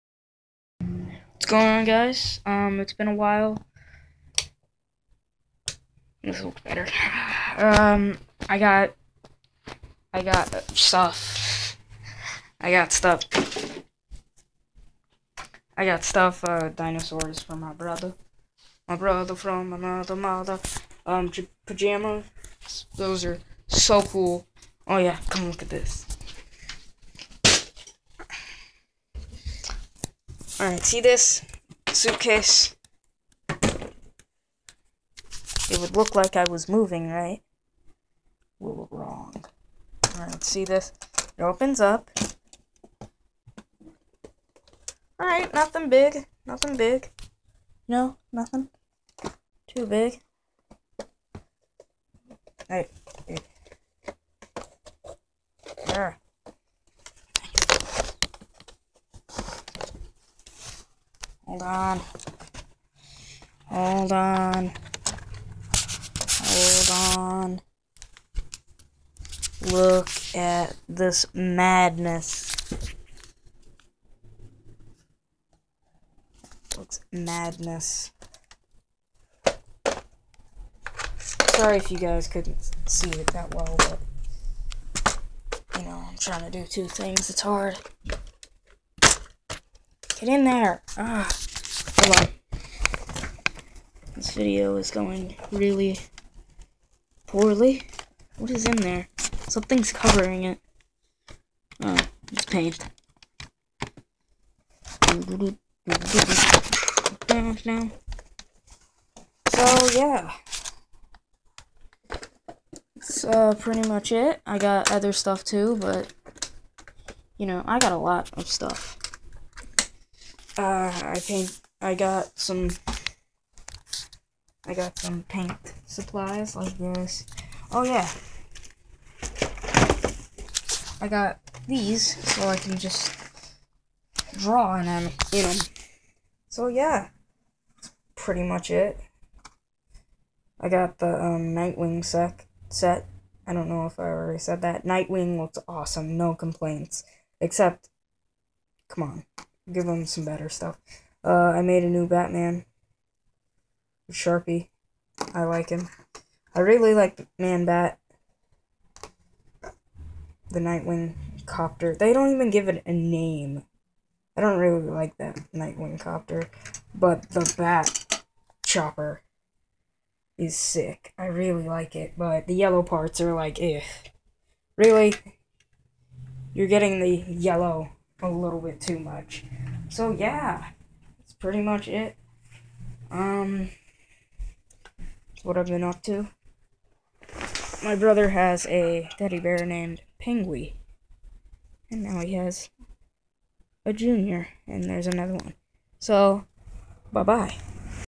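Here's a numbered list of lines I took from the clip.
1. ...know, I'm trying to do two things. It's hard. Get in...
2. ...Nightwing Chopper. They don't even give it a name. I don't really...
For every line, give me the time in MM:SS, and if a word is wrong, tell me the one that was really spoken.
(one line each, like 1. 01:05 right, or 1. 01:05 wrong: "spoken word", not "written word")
1. 01:25 right
2. 02:40 wrong: "Copter", not "Chopper".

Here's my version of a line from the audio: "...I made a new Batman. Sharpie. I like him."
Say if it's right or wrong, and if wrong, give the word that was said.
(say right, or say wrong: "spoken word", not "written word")
right.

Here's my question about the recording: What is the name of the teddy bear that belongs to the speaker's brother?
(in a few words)
Penguin.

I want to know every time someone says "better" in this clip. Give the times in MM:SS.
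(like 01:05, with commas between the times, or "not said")
00:06, 02:30.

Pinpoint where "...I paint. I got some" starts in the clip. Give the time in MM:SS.
02:01.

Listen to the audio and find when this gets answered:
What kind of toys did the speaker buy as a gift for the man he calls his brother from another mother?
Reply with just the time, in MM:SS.
00:16.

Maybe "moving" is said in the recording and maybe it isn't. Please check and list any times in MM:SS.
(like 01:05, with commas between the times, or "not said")
00:36.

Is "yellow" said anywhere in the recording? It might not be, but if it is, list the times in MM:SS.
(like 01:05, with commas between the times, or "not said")
02:52, 02:57.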